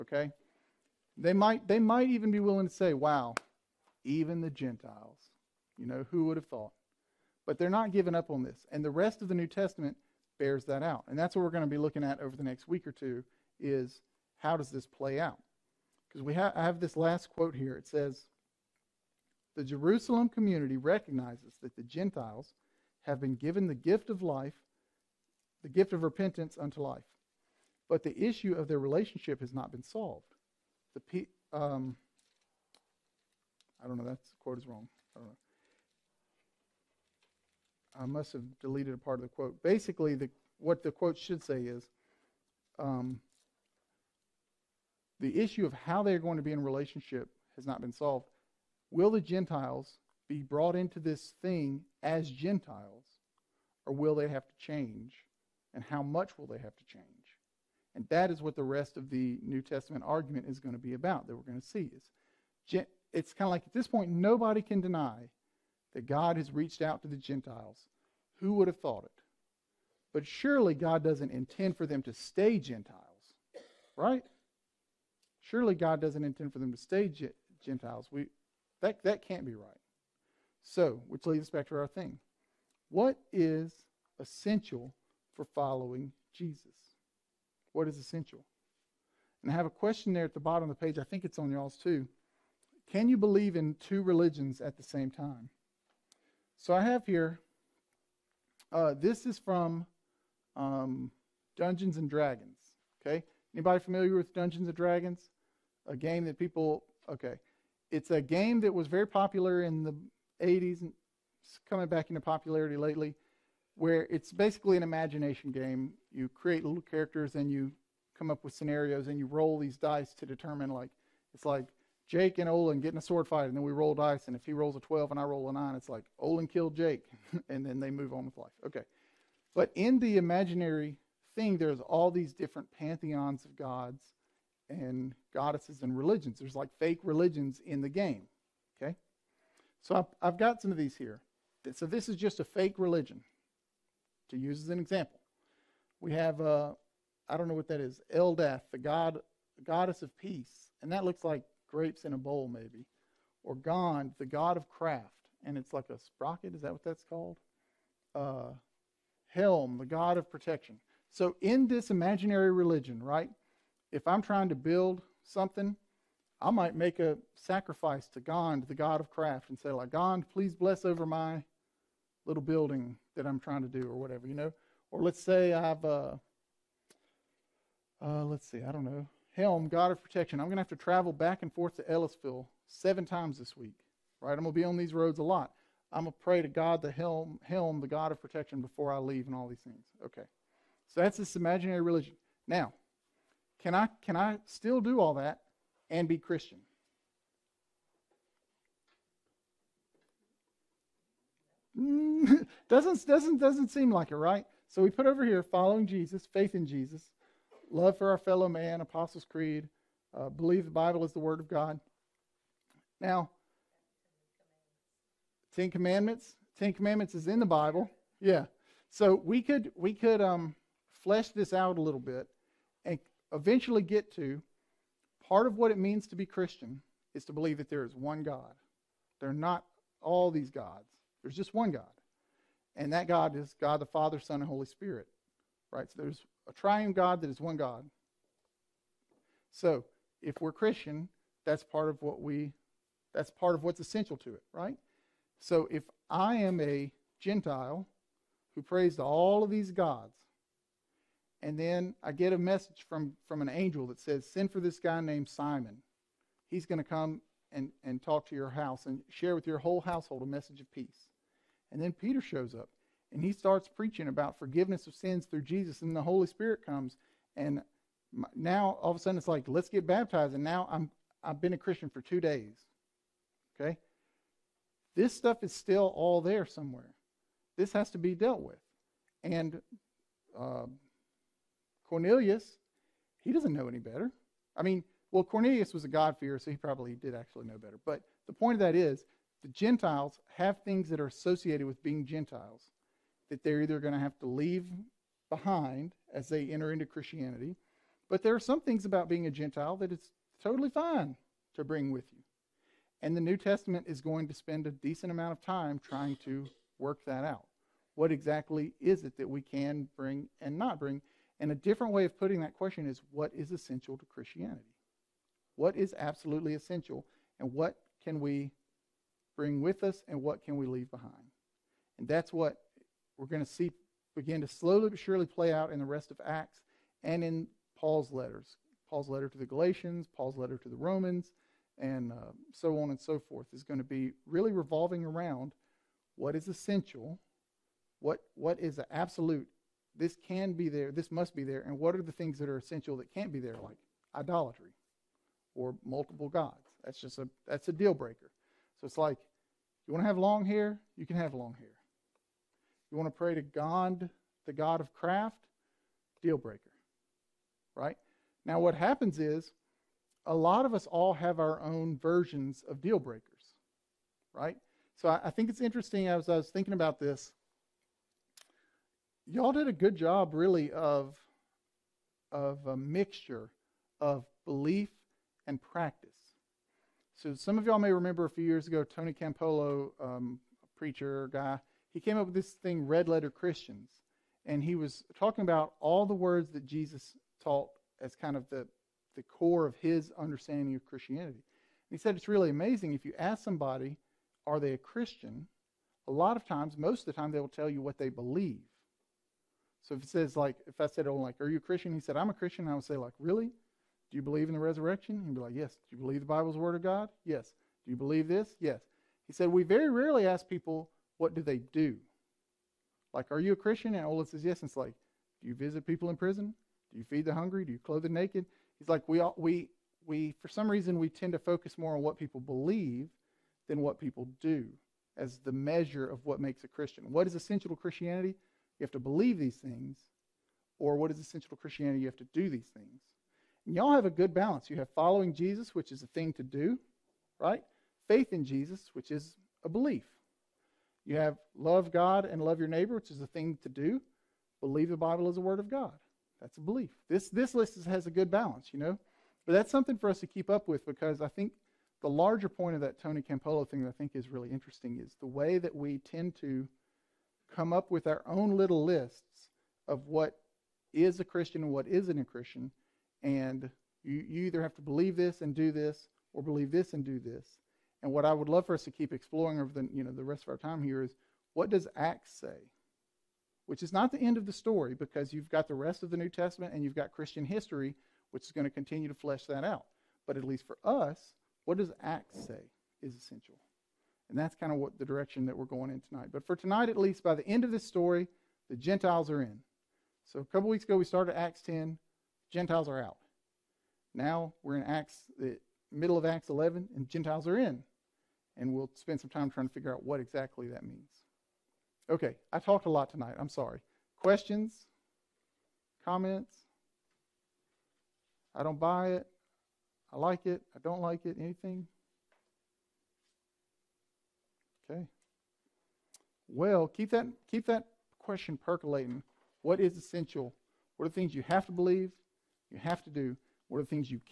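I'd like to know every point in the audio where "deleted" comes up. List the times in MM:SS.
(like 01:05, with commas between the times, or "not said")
00:38.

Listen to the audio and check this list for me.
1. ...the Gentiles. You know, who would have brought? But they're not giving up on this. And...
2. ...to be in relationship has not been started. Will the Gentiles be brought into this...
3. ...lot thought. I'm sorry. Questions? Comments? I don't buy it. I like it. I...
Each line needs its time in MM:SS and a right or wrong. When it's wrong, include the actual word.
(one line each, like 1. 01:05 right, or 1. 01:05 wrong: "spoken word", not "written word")
1. 00:04 wrong: "thought", not "brought"
2. 00:46 wrong: "solved", not "started"
3. 08:22 wrong: "tonight", not "thought".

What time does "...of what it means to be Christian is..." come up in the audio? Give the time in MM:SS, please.
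03:45.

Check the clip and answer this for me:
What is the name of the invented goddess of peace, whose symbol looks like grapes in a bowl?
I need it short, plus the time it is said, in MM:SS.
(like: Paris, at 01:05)
Eldath, at 02:28.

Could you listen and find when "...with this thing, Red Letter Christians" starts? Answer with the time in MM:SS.
06:22.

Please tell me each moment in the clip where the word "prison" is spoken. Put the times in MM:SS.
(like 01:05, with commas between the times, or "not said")
06:56.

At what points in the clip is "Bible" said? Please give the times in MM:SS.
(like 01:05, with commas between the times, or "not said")
03:30, 03:37, 06:46, 07:24.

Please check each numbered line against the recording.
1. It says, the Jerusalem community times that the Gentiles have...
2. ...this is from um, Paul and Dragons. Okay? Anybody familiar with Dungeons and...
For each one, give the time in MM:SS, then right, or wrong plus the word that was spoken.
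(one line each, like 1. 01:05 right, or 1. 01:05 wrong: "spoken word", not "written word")
1. 00:17 wrong: "recognizes", not "times"
2. 01:38 wrong: "Dungeons", not "Paul".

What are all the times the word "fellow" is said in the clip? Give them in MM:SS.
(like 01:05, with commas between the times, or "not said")
03:28.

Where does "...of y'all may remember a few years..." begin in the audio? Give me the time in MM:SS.
06:17.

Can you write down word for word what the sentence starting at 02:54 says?
Or let's say I've, uh, uh, let's see, I don't know.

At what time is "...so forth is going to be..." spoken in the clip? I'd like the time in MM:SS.
05:32.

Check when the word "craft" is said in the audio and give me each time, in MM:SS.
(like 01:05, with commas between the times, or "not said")
02:34, 02:49, 05:54.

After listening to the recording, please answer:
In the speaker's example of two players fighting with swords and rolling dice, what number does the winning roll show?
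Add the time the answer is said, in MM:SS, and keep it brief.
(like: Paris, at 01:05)
12, at 02:04.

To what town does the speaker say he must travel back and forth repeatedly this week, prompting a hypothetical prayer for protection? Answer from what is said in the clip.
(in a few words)
Ellisville.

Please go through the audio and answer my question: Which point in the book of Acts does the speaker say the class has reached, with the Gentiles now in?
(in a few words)
Middle of Acts 11.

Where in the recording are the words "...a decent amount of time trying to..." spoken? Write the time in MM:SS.
05:04.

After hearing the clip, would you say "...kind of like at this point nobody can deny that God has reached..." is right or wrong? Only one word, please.
right.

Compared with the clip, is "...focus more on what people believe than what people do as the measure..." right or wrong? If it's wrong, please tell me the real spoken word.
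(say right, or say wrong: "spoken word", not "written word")
right.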